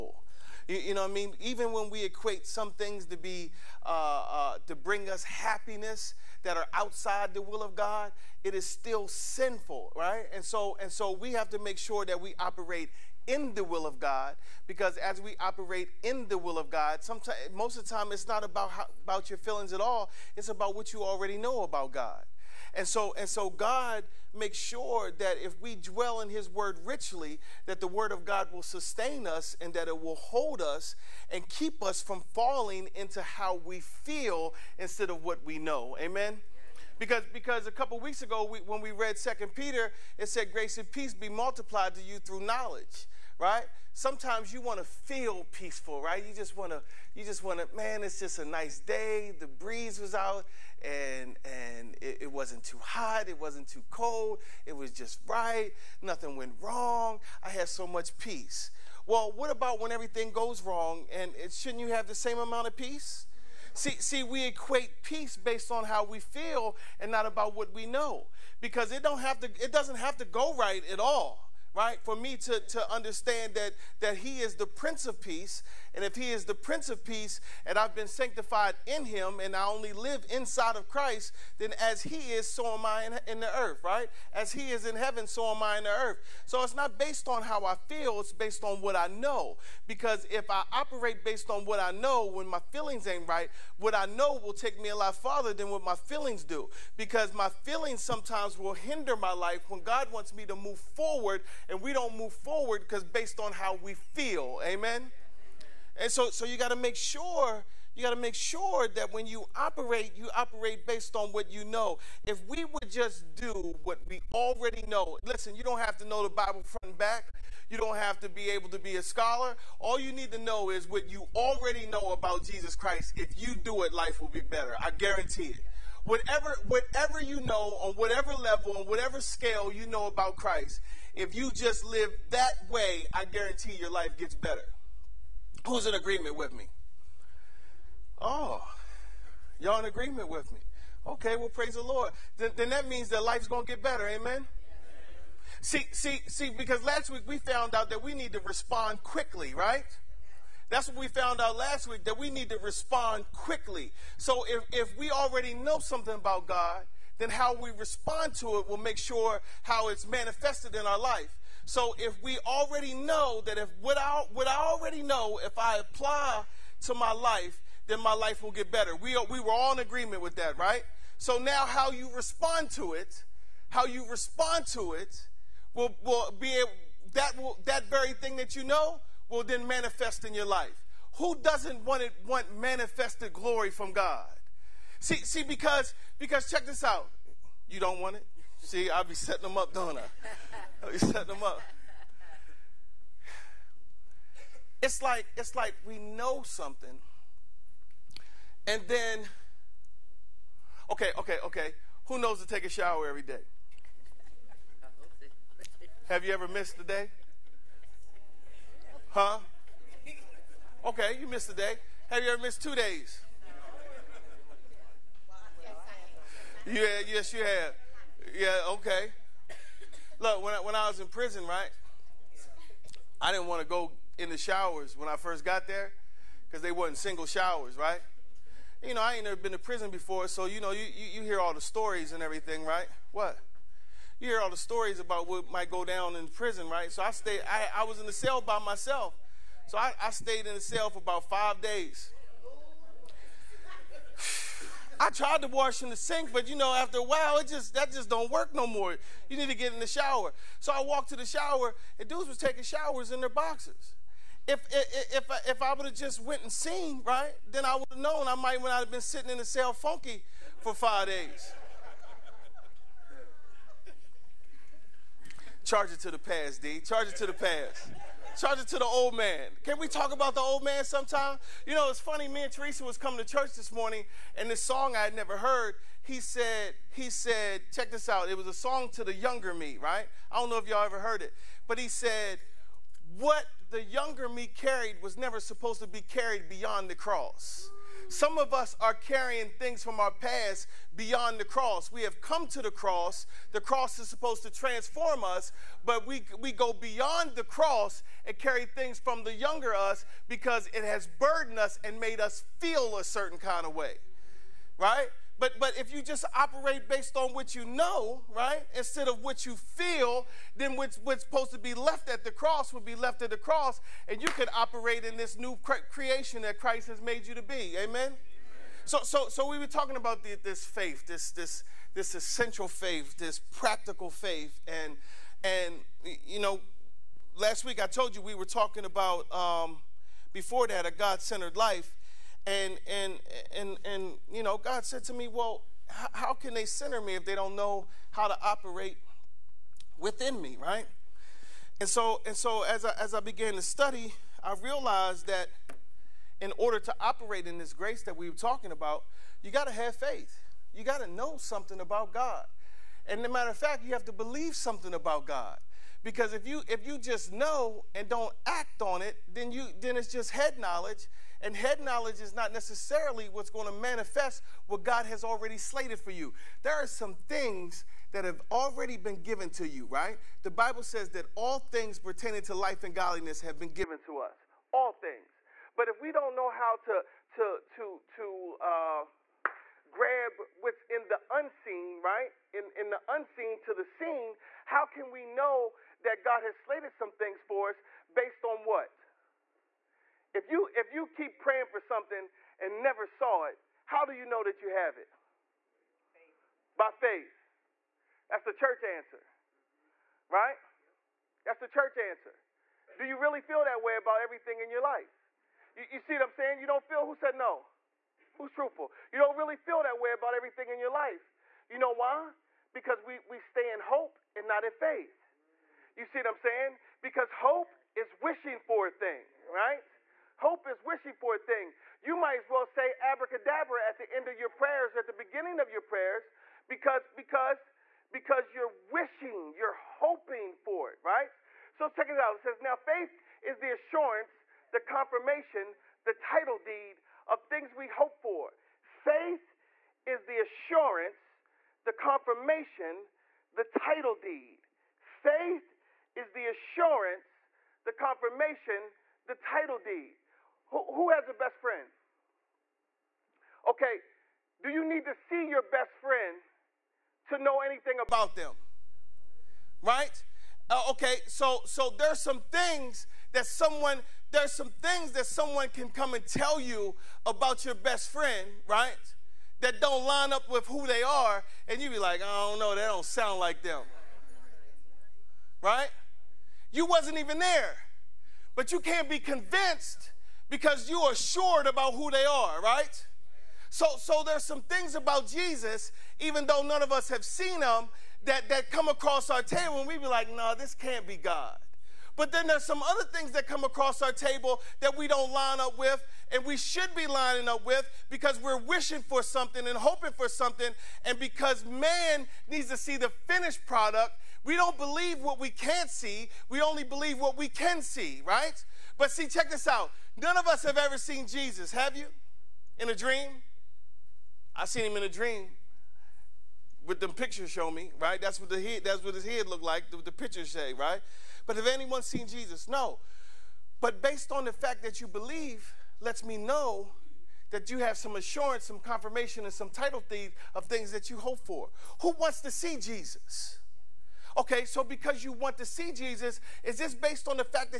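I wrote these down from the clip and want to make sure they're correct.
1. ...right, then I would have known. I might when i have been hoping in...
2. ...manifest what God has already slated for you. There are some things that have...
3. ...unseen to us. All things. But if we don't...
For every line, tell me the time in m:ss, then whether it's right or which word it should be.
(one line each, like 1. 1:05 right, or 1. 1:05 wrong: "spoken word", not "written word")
1. 4:17 wrong: "sitting", not "hoping"
2. 6:03 right
3. 6:13 wrong: "given", not "unseen".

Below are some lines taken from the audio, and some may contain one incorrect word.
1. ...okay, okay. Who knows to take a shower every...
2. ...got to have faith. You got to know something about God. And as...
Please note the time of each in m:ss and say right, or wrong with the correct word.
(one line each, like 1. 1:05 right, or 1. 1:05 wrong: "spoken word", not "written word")
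1. 3:21 right
2. 5:49 right.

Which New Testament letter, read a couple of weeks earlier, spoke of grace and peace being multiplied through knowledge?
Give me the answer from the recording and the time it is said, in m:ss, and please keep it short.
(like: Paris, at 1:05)
Second Peter, at 0:39.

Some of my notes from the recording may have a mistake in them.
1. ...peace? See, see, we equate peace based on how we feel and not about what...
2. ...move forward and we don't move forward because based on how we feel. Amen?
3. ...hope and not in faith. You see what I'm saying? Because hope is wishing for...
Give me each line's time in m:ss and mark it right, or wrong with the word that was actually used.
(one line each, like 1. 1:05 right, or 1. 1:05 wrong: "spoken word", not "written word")
1. 1:02 right
2. 1:40 right
3. 6:53 right.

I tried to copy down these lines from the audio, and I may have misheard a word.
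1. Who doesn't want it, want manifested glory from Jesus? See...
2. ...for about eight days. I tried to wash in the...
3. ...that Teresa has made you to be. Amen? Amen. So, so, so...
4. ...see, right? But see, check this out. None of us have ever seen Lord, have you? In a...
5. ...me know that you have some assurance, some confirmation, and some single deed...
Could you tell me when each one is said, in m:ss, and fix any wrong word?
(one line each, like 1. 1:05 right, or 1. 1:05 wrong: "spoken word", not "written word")
1. 3:01 wrong: "God", not "Jesus"
2. 4:00 wrong: "five", not "eight"
3. 5:16 wrong: "Christ", not "Teresa"
4. 8:27 wrong: "Jesus", not "Lord"
5. 8:46 wrong: "title", not "single".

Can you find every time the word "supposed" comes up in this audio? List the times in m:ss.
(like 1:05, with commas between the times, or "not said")
4:45, 4:54, 5:11.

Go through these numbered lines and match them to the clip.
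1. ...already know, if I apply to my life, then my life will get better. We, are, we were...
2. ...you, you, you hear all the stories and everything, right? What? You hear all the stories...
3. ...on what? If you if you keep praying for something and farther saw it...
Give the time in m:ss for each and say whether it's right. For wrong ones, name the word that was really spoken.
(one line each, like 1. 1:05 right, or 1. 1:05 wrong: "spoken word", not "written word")
1. 2:44 right
2. 3:50 right
3. 6:28 wrong: "never", not "farther".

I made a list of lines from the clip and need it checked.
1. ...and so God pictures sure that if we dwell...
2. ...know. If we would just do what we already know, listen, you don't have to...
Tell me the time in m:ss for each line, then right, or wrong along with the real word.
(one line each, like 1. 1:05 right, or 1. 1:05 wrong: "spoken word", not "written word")
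1. 0:23 wrong: "makes", not "pictures"
2. 1:51 right.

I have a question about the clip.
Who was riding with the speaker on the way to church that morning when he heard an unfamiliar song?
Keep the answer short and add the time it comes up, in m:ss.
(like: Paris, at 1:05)
Teresa, at 4:32.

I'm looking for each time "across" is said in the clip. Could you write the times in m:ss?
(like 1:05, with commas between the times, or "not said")
8:08, 8:13.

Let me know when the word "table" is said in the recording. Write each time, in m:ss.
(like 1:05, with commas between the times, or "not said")
8:09, 8:14.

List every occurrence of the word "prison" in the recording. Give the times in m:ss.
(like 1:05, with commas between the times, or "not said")
3:41, 3:49, 3:56.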